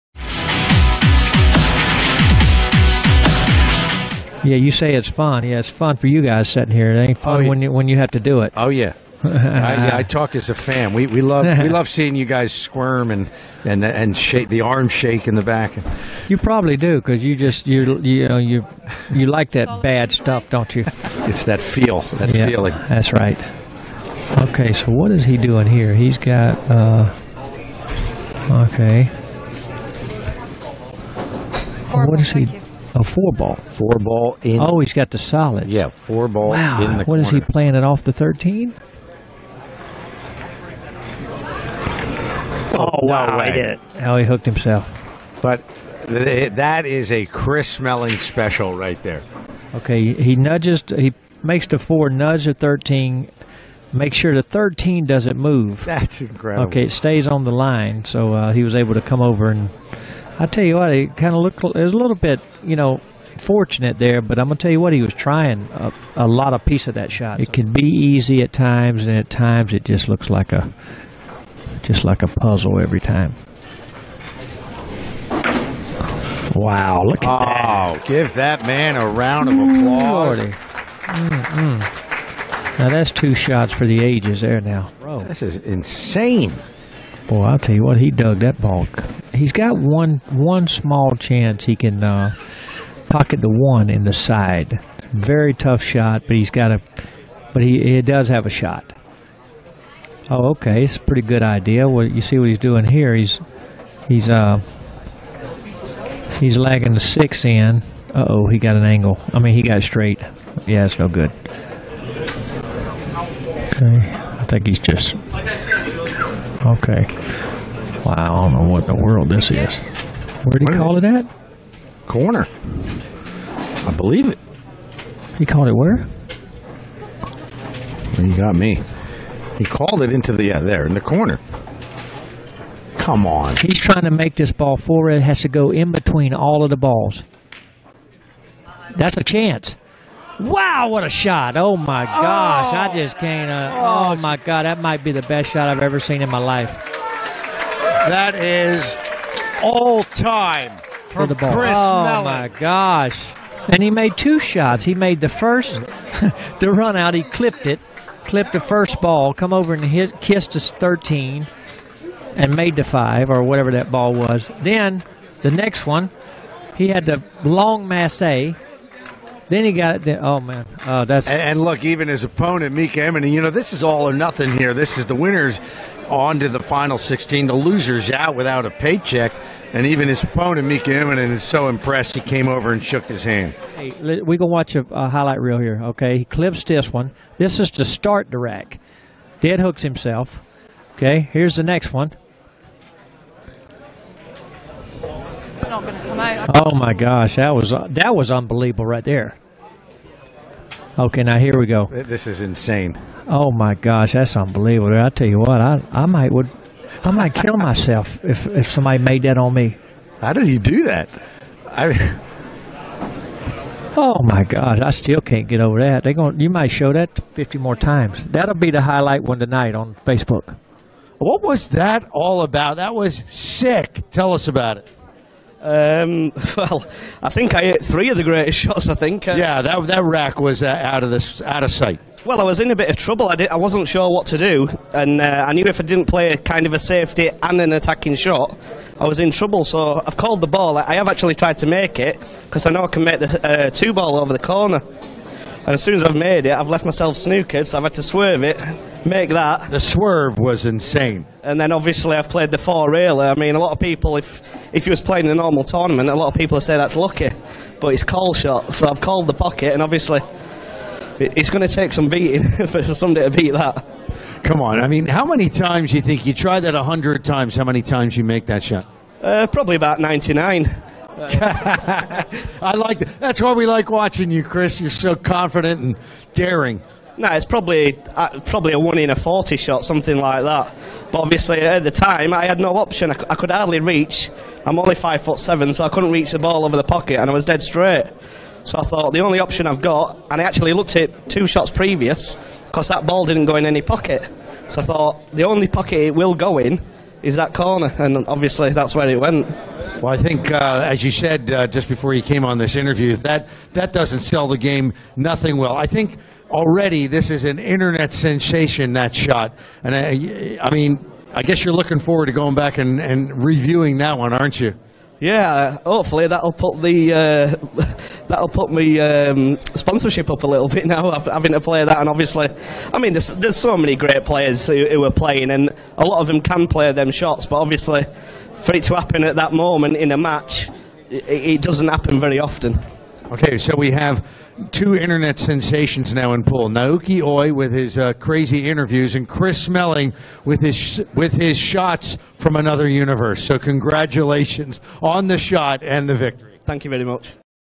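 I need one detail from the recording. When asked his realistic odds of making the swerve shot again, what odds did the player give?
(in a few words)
1 in 40.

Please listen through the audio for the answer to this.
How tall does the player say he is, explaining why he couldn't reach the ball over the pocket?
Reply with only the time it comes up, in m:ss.
4:44.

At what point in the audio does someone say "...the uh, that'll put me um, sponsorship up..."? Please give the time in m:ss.
5:16.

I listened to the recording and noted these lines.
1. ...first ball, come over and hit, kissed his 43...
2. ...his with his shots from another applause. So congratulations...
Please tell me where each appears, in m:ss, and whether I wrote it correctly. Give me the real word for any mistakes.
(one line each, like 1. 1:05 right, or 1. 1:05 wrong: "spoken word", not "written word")
1. 2:38 wrong: "13", not "43"
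2. 5:40 wrong: "universe", not "applause".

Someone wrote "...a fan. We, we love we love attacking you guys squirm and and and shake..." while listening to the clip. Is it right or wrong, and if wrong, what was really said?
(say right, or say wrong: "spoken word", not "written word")
wrong: "seeing", not "attacking".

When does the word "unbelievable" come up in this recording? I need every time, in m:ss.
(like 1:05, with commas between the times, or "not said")
3:18, 3:24.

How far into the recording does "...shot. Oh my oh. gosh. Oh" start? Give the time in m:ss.
2:21.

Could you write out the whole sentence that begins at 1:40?
Oh, okay, it's a pretty good idea.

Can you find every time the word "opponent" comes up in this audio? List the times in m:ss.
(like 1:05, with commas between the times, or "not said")
2:52, 3:00.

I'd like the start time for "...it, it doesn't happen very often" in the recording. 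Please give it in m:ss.
5:31.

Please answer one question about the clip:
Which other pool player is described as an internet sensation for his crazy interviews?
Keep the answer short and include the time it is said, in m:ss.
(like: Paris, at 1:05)
Naoyuki Oi, at 5:36.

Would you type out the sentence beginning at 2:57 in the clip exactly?
The losers out without a paycheck.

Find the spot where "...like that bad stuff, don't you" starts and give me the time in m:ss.
0:19.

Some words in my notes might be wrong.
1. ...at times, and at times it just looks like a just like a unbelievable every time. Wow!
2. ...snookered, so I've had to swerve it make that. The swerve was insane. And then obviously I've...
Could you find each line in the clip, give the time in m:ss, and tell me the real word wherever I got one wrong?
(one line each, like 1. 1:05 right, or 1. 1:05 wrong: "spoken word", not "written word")
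1. 1:08 wrong: "puzzle", not "unbelievable"
2. 4:07 right.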